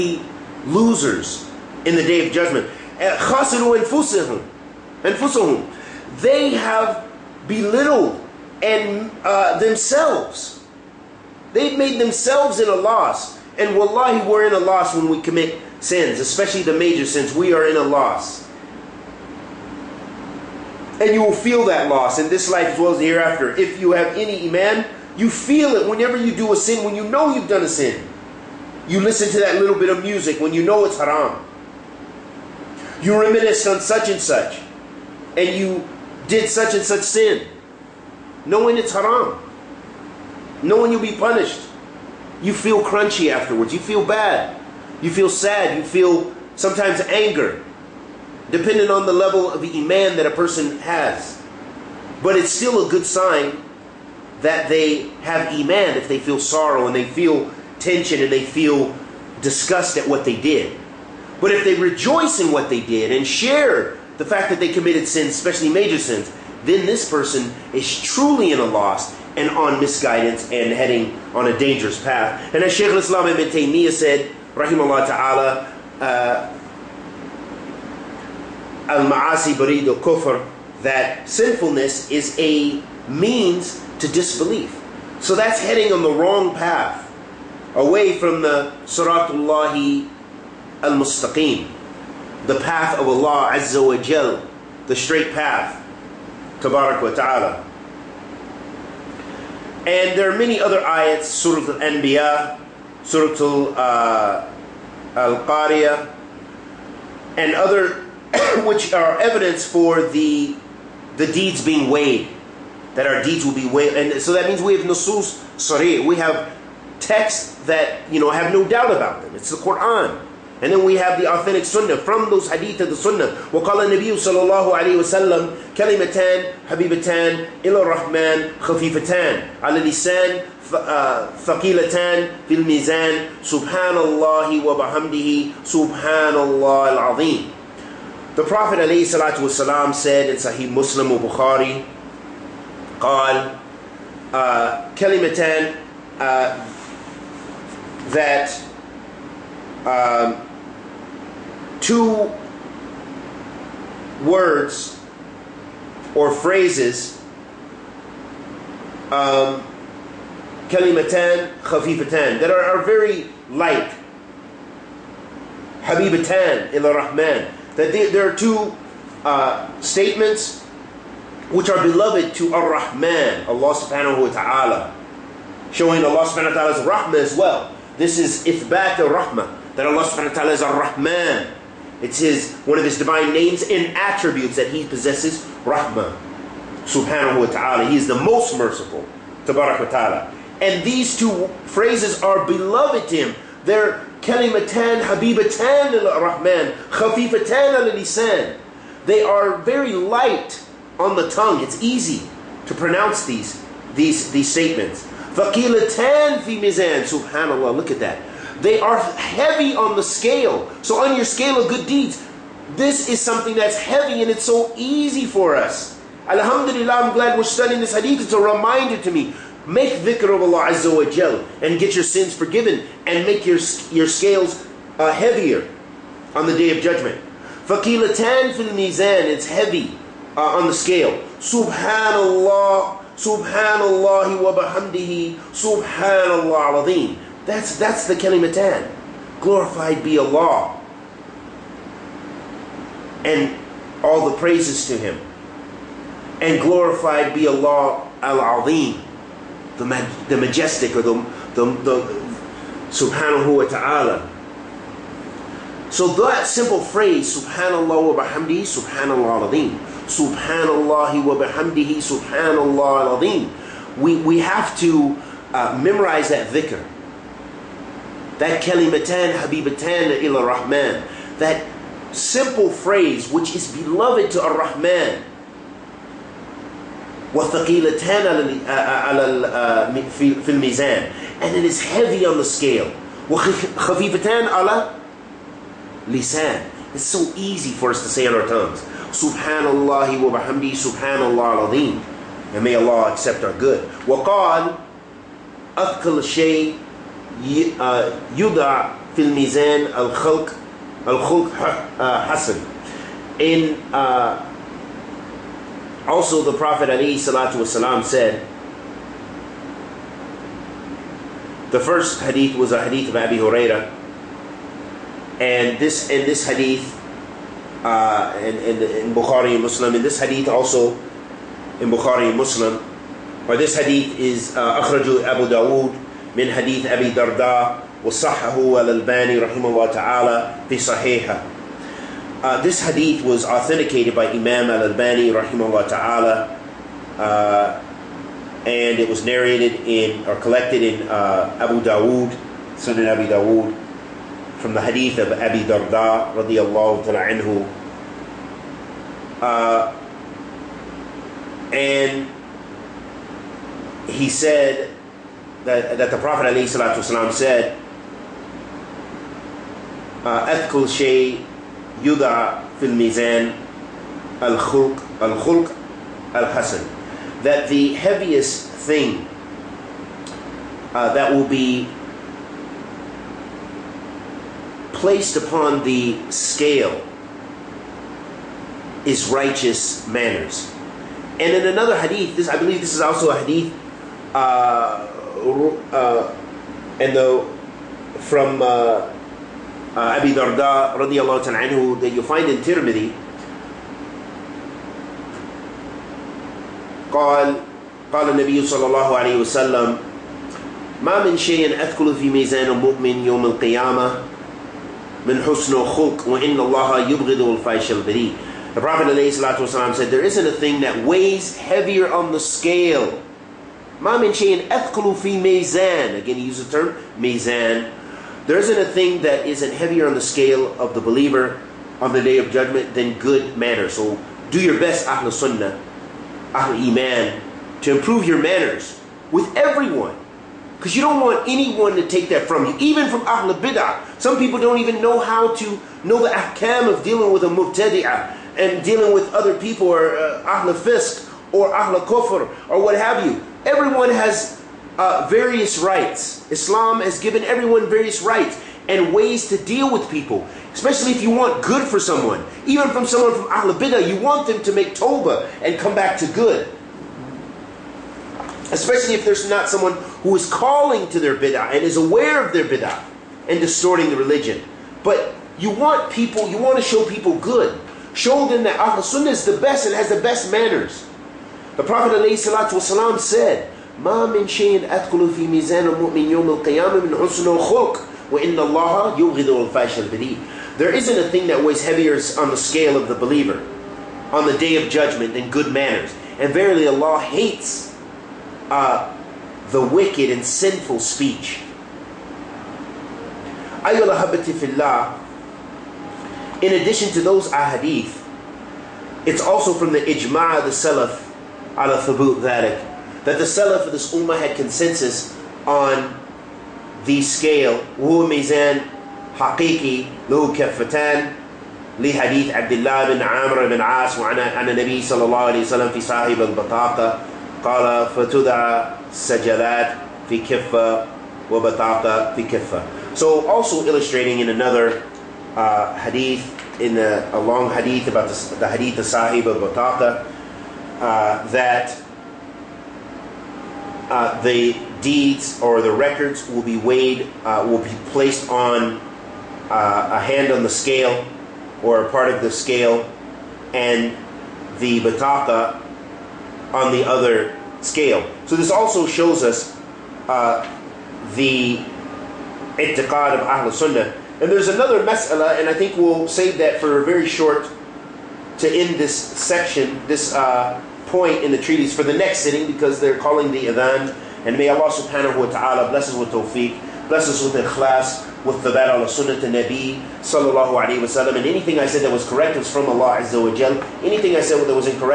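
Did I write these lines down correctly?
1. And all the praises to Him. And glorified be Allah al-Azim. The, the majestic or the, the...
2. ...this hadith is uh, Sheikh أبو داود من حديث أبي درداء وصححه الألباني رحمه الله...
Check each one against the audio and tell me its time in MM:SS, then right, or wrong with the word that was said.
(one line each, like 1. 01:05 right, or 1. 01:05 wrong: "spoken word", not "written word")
1. 04:03 right
2. 05:23 wrong: "Abu", not "Sheikh".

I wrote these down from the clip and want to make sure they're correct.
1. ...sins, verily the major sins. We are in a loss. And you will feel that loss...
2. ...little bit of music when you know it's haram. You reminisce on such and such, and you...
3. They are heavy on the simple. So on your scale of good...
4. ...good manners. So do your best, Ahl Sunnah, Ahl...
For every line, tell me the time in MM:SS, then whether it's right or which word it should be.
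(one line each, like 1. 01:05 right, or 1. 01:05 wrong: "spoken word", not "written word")
1. 00:15 wrong: "especially", not "verily"
2. 00:29 right
3. 03:28 wrong: "scale", not "simple"
4. 07:03 right.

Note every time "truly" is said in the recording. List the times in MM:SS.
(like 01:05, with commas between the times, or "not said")
01:08.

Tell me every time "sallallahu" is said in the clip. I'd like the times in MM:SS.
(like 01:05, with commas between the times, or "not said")
08:35, 09:30.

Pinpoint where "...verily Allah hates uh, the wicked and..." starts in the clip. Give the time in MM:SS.
08:06.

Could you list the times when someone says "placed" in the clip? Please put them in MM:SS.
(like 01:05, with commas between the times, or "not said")
06:14, 08:58.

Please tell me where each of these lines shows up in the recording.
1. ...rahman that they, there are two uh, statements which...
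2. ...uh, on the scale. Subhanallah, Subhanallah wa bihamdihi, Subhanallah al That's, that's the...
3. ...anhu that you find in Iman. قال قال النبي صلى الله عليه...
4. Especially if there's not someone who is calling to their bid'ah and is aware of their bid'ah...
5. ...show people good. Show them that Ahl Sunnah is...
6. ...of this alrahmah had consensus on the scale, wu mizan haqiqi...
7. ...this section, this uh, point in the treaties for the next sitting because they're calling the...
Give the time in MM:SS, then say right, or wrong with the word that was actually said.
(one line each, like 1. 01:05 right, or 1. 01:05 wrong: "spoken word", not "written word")
1. 02:46 right
2. 03:50 right
3. 06:31 wrong: "Tirmidhi", not "Iman"
4. 07:38 right
5. 07:46 right
6. 08:23 wrong: "ummah", not "alrahmah"
7. 09:18 right.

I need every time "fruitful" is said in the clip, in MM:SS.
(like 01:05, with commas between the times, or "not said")
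not said.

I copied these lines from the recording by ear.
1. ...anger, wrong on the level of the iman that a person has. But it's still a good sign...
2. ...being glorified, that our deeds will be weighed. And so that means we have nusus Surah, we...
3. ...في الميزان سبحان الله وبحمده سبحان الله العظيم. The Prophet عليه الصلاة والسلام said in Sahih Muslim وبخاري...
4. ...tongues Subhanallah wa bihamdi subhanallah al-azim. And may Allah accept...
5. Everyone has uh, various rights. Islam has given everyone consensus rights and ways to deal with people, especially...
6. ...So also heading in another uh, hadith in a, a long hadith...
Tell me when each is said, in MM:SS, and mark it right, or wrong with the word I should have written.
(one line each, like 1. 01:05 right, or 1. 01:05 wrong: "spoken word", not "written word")
1. 00:47 wrong: "depending", not "wrong"
2. 01:51 wrong: "weighed", not "glorified"
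3. 02:12 right
4. 04:48 right
5. 07:23 wrong: "various", not "consensus"
6. 08:43 wrong: "illustrating", not "heading".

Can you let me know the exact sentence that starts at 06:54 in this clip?
Mamin shayin fi Mezan." Again, he used the term Mezan.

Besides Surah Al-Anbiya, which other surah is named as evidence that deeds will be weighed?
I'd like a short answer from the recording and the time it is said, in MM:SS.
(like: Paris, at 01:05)
Al-Qariya, at 01:45.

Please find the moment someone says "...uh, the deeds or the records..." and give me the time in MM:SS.
08:54.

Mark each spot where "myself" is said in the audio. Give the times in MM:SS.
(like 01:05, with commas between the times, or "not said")
not said.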